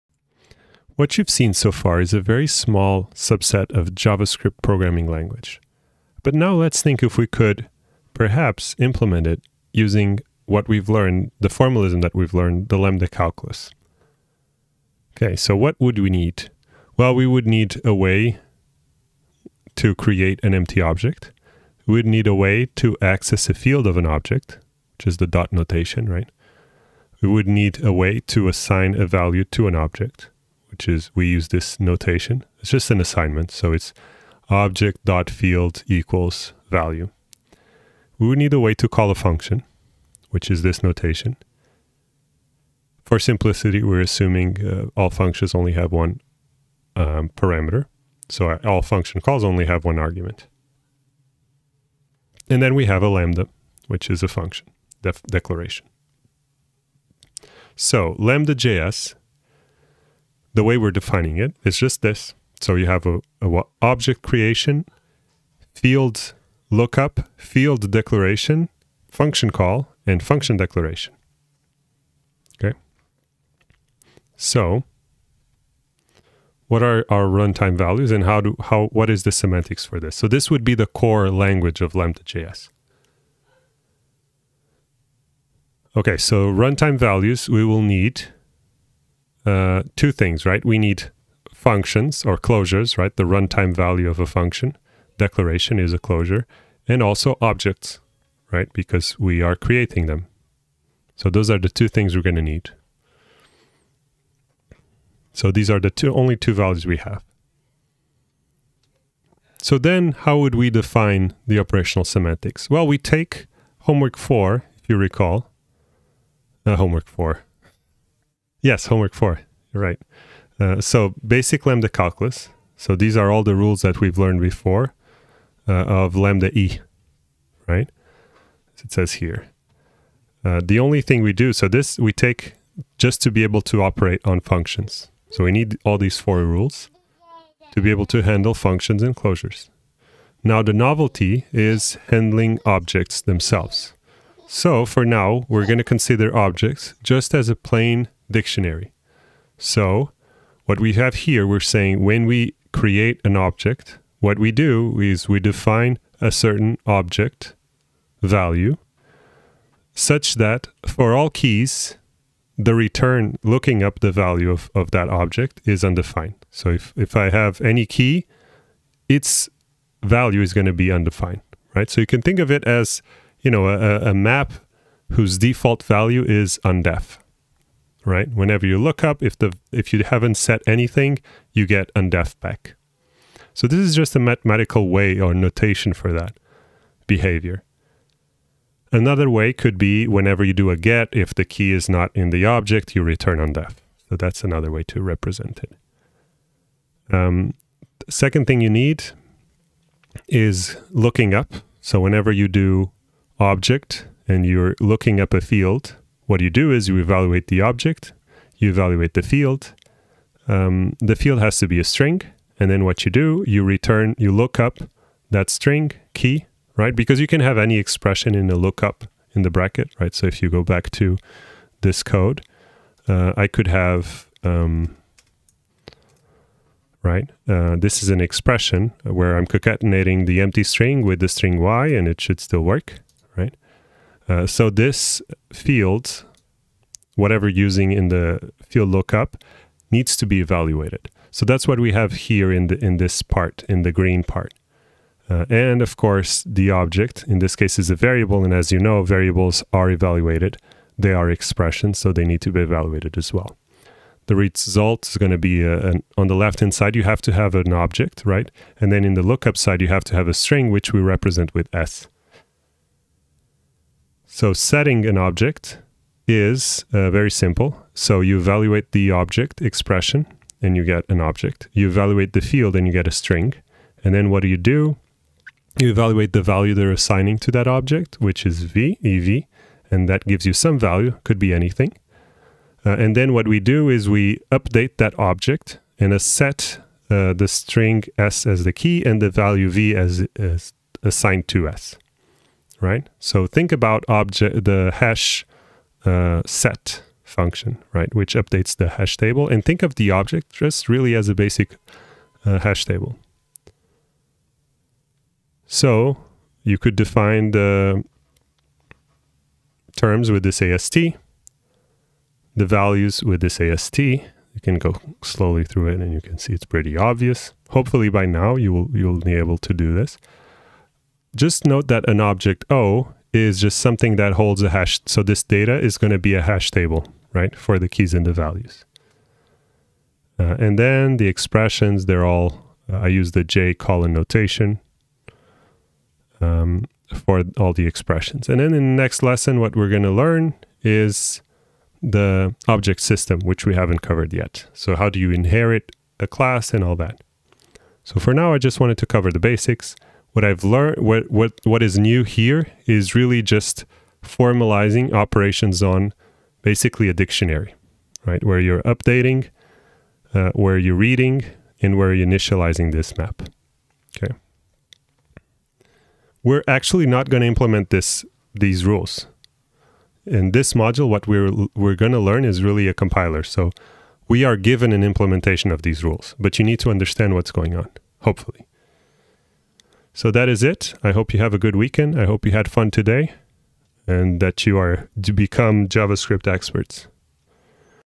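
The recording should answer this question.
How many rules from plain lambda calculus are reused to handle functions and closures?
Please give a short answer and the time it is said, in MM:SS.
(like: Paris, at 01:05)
4, at 02:16.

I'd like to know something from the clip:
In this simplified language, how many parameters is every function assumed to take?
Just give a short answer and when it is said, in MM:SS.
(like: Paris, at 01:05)
1, at 00:45.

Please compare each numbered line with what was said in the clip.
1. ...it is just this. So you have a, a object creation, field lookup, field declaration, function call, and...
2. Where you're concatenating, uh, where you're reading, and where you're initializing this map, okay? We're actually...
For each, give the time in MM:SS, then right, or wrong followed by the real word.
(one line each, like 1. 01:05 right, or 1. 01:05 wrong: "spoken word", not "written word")
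1. 01:01 right
2. 05:58 wrong: "updating", not "concatenating".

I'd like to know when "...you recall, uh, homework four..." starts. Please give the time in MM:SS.
01:54.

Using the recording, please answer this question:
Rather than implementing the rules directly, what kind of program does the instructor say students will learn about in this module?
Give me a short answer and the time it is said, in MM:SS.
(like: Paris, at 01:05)
A compiler, at 06:12.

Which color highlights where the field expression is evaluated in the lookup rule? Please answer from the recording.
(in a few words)
Green.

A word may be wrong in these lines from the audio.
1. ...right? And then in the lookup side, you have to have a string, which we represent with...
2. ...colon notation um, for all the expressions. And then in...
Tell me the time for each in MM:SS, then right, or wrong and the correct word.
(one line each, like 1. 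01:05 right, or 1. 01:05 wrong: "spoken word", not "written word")
1. 04:18 right
2. 05:33 right.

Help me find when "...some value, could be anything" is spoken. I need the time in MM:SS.
04:40.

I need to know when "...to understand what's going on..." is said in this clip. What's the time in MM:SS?
06:16.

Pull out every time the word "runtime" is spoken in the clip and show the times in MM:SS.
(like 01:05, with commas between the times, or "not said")
01:17, 01:26, 01:33.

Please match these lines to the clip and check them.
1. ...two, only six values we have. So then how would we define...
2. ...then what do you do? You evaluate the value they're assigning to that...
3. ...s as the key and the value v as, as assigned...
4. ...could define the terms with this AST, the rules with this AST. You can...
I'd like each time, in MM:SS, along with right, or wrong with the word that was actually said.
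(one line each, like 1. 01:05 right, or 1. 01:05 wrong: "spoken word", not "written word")
1. 01:45 wrong: "two", not "six"
2. 04:34 right
3. 04:48 right
4. 05:06 wrong: "values", not "rules".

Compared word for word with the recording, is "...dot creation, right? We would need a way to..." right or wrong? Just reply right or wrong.
wrong.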